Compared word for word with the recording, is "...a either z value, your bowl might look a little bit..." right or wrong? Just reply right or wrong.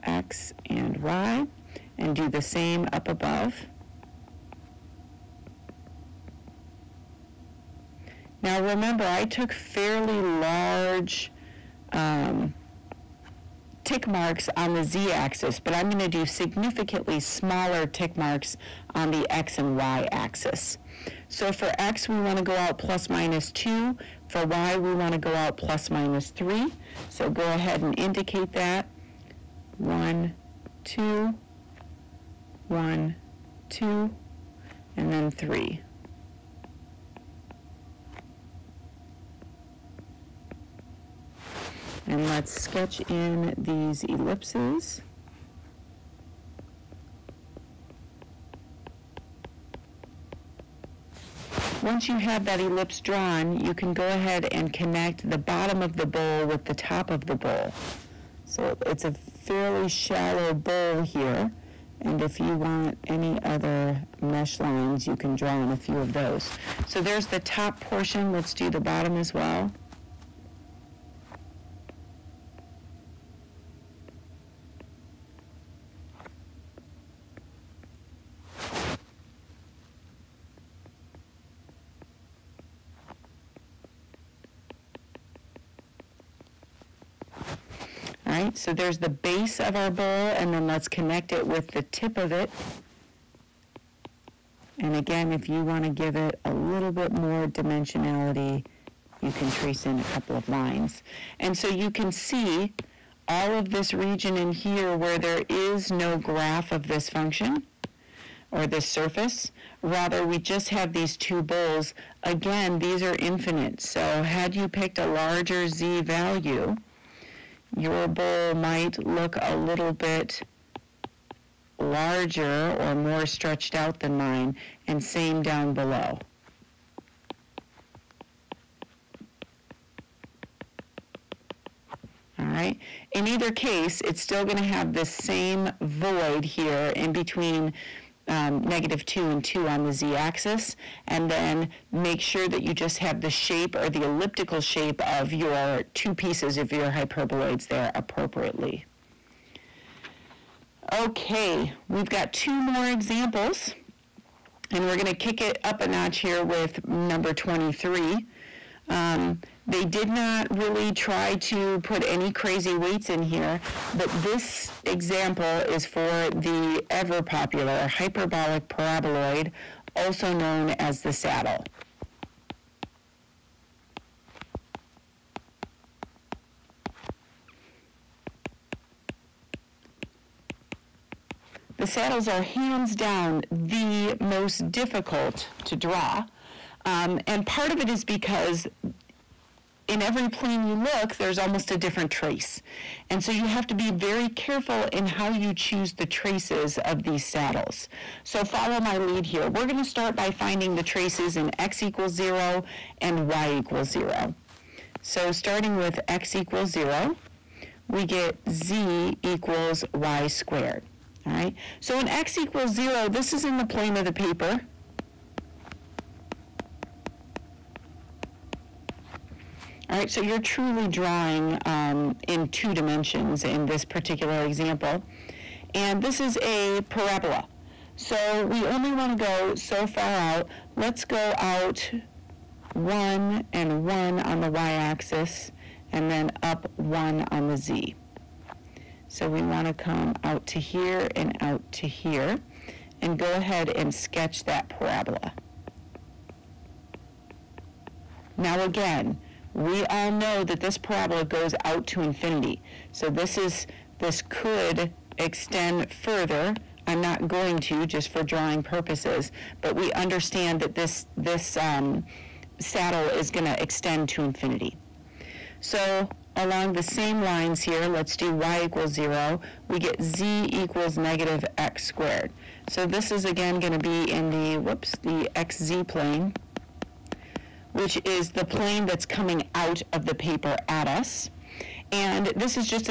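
wrong.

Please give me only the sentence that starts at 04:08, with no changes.
Now again, we all know that this parabola goes out to infinity.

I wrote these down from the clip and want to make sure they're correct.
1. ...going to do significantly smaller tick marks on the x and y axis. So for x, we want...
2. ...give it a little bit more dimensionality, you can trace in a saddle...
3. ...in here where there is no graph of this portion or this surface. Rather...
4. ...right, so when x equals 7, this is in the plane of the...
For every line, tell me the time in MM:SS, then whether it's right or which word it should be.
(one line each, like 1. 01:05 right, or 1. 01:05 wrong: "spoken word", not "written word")
1. 00:15 right
2. 01:35 wrong: "couple", not "saddle"
3. 01:44 wrong: "function", not "portion"
4. 03:31 wrong: "0", not "7".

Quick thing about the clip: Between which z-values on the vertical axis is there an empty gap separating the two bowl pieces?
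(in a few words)
-2 and 2.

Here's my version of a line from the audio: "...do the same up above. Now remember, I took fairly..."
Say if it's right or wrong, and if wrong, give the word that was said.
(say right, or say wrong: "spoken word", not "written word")
right.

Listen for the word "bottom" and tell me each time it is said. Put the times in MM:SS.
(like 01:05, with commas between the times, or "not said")
00:55, 01:08.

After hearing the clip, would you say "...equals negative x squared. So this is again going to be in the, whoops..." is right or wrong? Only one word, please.
right.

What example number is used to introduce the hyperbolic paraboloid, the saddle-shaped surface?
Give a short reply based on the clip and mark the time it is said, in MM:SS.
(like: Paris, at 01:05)
23, at 02:36.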